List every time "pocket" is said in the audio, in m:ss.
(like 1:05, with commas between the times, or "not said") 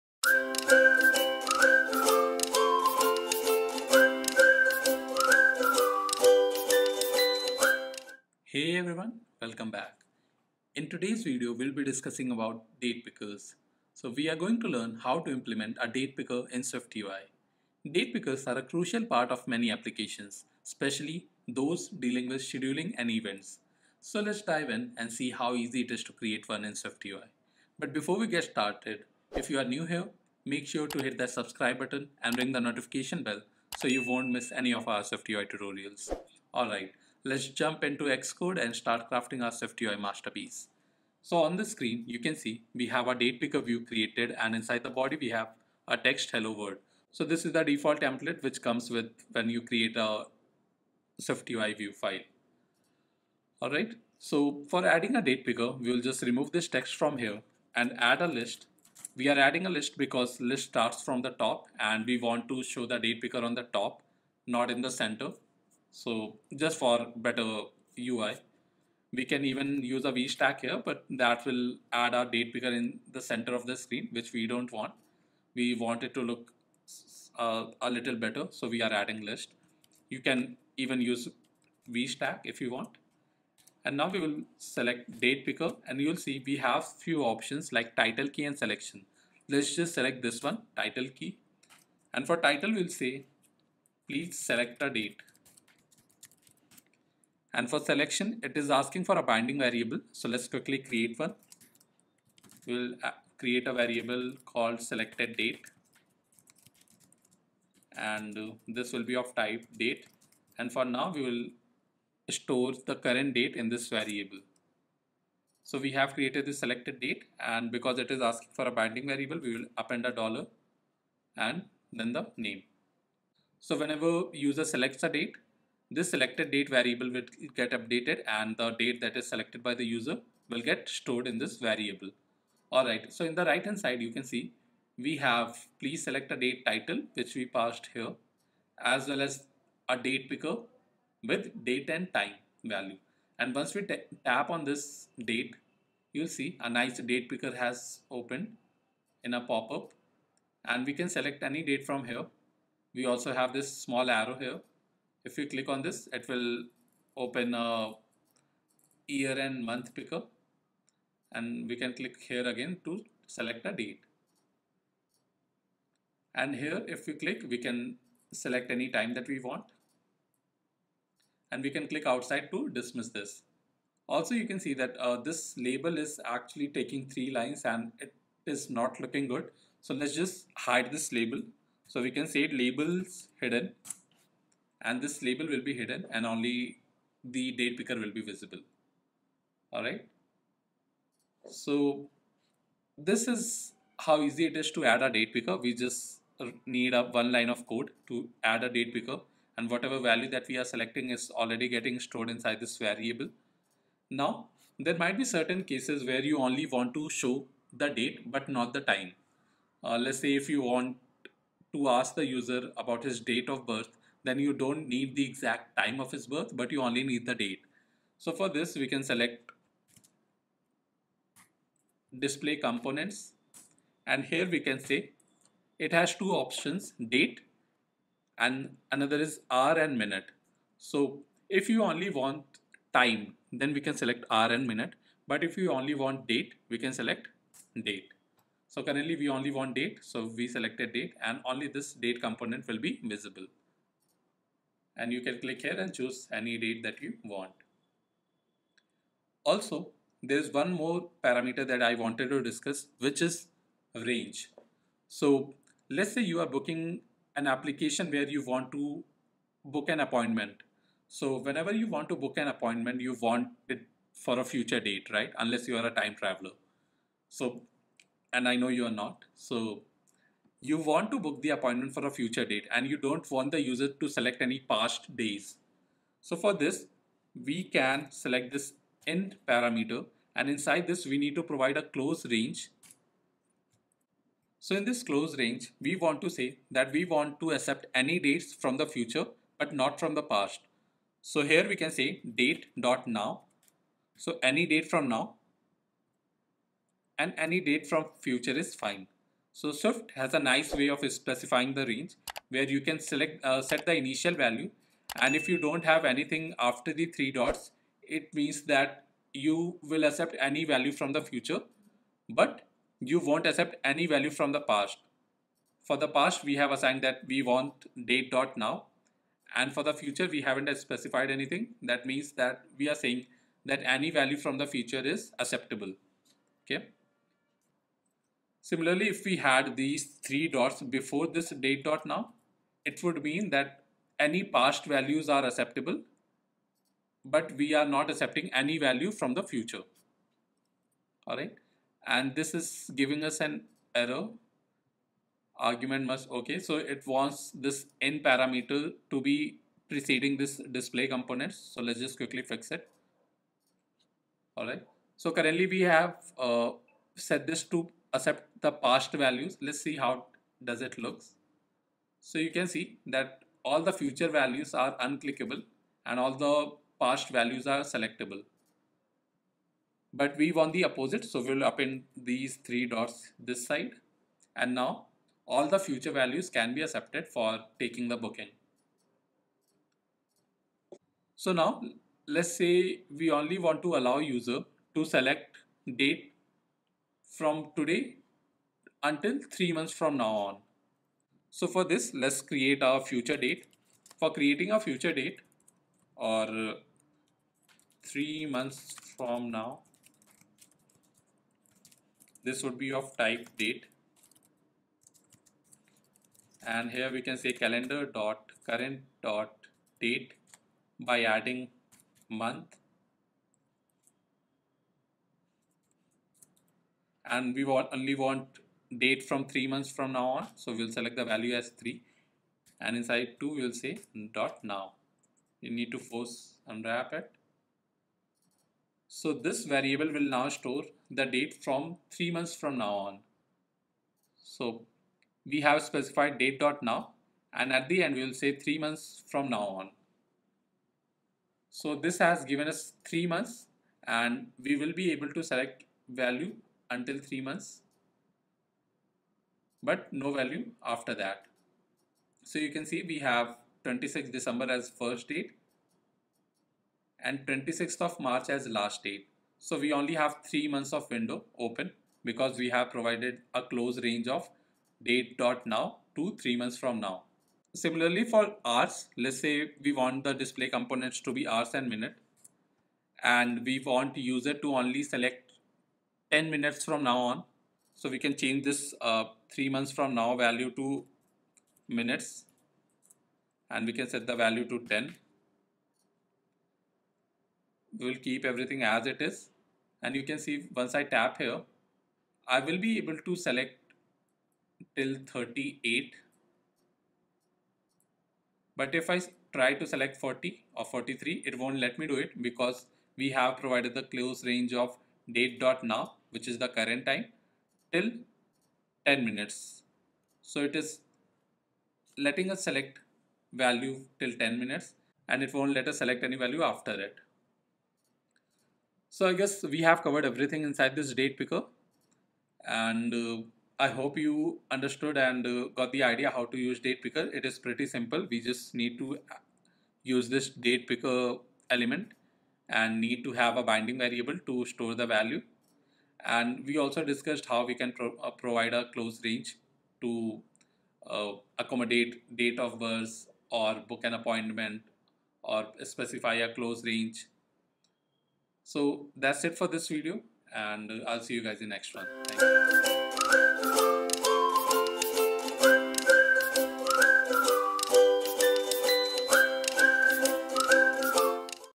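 not said.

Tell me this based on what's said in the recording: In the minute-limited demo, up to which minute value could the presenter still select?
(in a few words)
38.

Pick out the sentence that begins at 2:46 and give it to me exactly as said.
And here if we click, we can select any time that we want.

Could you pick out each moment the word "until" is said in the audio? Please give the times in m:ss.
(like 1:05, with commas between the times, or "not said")
6:29, 7:26.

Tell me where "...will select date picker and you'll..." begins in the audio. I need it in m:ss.
1:24.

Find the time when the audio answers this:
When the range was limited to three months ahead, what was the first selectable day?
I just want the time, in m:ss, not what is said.
7:33.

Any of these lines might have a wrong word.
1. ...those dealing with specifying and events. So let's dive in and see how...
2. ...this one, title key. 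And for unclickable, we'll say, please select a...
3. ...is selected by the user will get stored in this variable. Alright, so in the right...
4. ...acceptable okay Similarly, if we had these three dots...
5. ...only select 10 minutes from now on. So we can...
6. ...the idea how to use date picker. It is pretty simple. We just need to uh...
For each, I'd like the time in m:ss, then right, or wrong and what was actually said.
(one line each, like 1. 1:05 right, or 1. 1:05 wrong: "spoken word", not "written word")
1. 0:21 wrong: "scheduling", not "specifying"
2. 1:30 wrong: "title", not "unclickable"
3. 2:09 right
4. 5:25 right
5. 7:54 right
6. 8:45 right.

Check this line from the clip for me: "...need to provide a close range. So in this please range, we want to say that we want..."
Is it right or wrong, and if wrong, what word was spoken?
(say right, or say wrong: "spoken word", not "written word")
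wrong: "close", not "please".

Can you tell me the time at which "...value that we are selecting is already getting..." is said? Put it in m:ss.
3:19.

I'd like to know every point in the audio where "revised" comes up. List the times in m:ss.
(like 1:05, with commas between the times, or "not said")
not said.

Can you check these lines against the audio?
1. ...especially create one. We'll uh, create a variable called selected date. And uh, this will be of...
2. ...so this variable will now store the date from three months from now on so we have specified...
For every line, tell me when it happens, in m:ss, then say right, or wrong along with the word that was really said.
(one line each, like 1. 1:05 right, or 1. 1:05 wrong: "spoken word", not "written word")
1. 1:40 wrong: "quickly", not "especially"
2. 7:09 right.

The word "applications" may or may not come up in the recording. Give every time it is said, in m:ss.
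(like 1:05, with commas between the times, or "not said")
0:19, 4:17.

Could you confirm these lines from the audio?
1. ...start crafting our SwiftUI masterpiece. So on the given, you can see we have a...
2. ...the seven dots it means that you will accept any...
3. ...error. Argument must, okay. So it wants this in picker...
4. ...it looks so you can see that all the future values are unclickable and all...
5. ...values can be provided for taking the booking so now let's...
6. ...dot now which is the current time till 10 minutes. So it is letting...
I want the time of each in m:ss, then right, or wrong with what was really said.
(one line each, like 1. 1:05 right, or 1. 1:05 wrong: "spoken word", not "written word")
1. 0:38 wrong: "screen", not "given"
2. 5:06 wrong: "three", not "seven"
3. 5:43 wrong: "parameter", not "picker"
4. 6:00 right
5. 6:16 wrong: "accepted", not "provided"
6. 8:25 right.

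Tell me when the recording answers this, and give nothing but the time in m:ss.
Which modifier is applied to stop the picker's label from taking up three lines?
3:02.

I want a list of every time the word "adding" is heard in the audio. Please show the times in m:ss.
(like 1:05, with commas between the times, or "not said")
0:54, 0:59, 1:18, 6:51.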